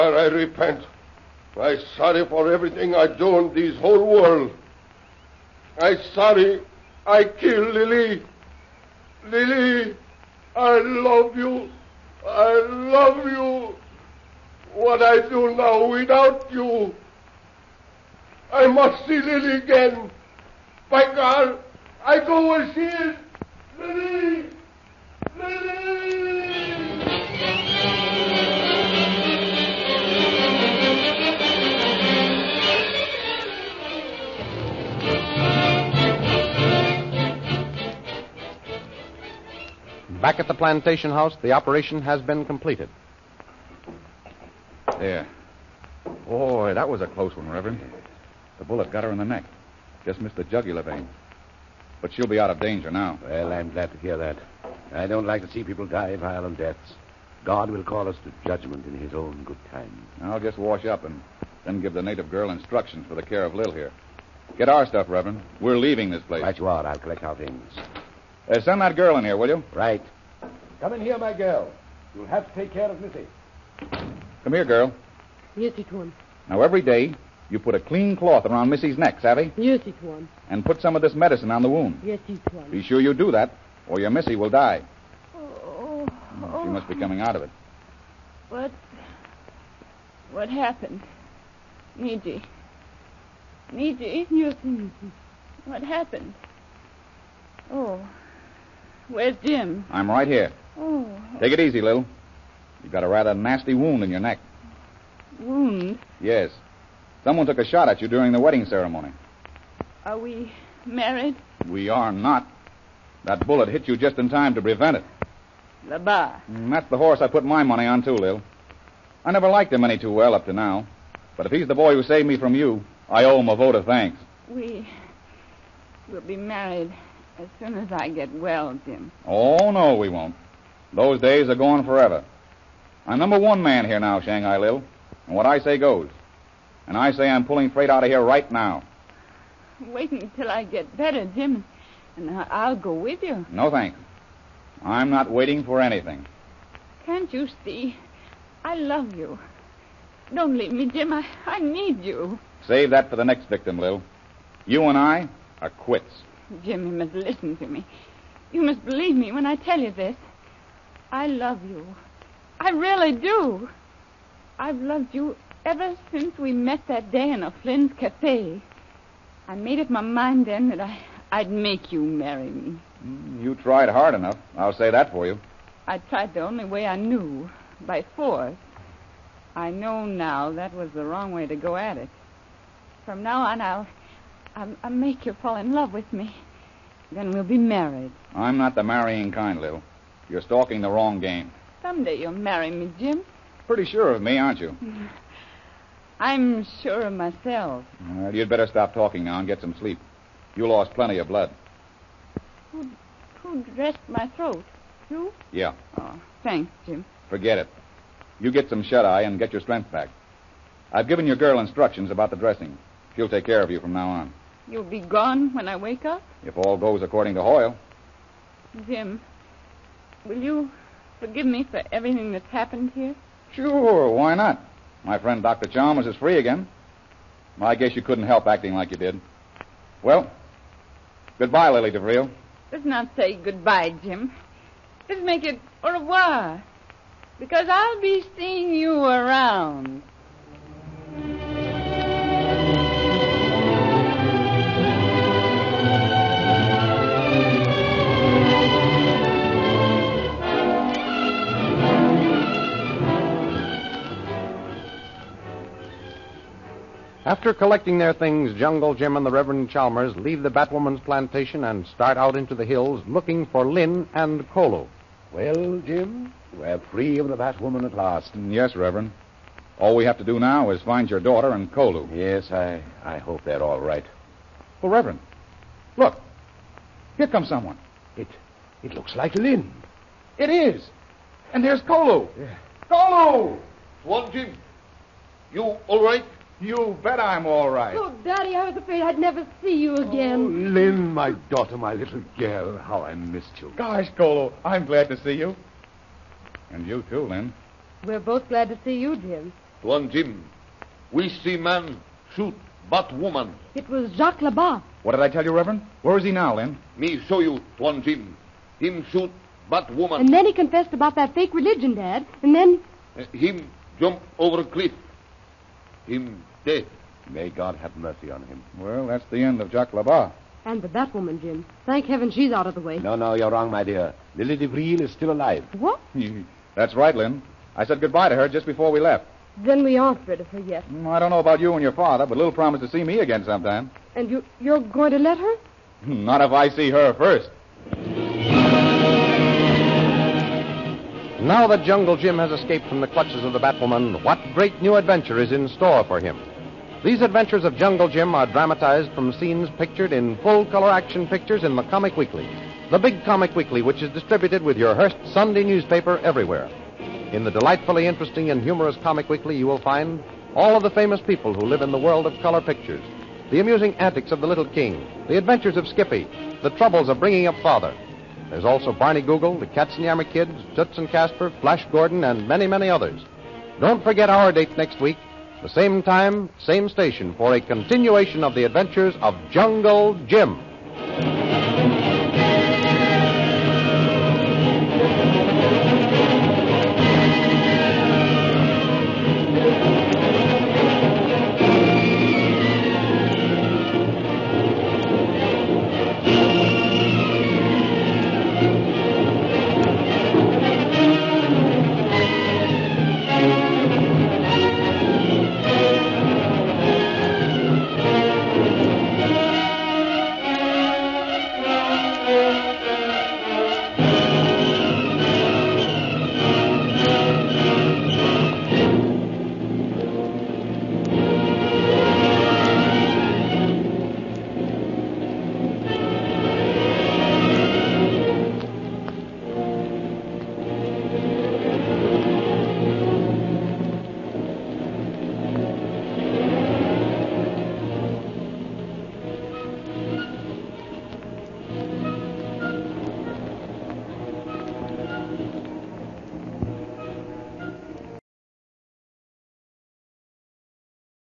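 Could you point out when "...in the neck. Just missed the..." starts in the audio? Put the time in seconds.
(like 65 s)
49 s.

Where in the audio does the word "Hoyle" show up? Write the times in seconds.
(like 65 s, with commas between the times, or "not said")
217 s.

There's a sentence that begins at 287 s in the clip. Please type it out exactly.
Oh, Daddy, I was afraid I'd never see you again.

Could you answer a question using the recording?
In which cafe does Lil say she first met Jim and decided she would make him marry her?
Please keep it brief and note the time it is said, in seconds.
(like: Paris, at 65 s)
O'Flynn's cafe, at 167 s.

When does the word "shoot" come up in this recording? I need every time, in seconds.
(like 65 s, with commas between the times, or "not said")
302 s, 309 s.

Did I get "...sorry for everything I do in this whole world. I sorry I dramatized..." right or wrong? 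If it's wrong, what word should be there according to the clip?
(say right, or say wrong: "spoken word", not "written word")
wrong: "killed", not "dramatized".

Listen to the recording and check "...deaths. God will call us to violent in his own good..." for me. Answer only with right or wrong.
wrong.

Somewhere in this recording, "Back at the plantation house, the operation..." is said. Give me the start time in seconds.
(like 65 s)
40 s.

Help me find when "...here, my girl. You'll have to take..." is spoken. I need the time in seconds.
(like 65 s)
71 s.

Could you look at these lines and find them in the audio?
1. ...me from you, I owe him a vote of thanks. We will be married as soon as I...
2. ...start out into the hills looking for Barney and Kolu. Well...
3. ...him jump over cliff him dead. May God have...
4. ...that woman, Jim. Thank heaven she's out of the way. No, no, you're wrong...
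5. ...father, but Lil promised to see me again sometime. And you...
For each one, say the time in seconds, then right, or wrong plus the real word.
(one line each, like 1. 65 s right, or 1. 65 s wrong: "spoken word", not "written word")
1. 122 s right
2. 261 s wrong: "Lynn", not "Barney"
3. 313 s right
4. 320 s right
5. 331 s right.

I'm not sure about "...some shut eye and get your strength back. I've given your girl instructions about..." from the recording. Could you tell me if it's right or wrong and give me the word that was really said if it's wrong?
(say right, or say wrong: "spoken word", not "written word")
right.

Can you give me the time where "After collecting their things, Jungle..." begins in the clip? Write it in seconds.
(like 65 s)
257 s.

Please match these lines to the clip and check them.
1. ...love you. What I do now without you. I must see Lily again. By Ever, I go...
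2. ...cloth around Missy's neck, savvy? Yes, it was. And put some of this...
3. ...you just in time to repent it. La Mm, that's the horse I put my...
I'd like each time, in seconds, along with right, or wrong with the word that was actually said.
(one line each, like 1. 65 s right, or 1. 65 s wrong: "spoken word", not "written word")
1. 12 s wrong: "God", not "Ever"
2. 78 s right
3. 113 s wrong: "prevent", not "repent".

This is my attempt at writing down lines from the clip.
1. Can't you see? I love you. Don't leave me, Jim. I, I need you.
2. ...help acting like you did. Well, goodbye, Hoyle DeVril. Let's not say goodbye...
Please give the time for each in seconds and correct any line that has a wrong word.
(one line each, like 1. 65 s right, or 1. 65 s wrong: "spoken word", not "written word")
1. 147 s right
2. 228 s wrong: "Lily", not "Hoyle".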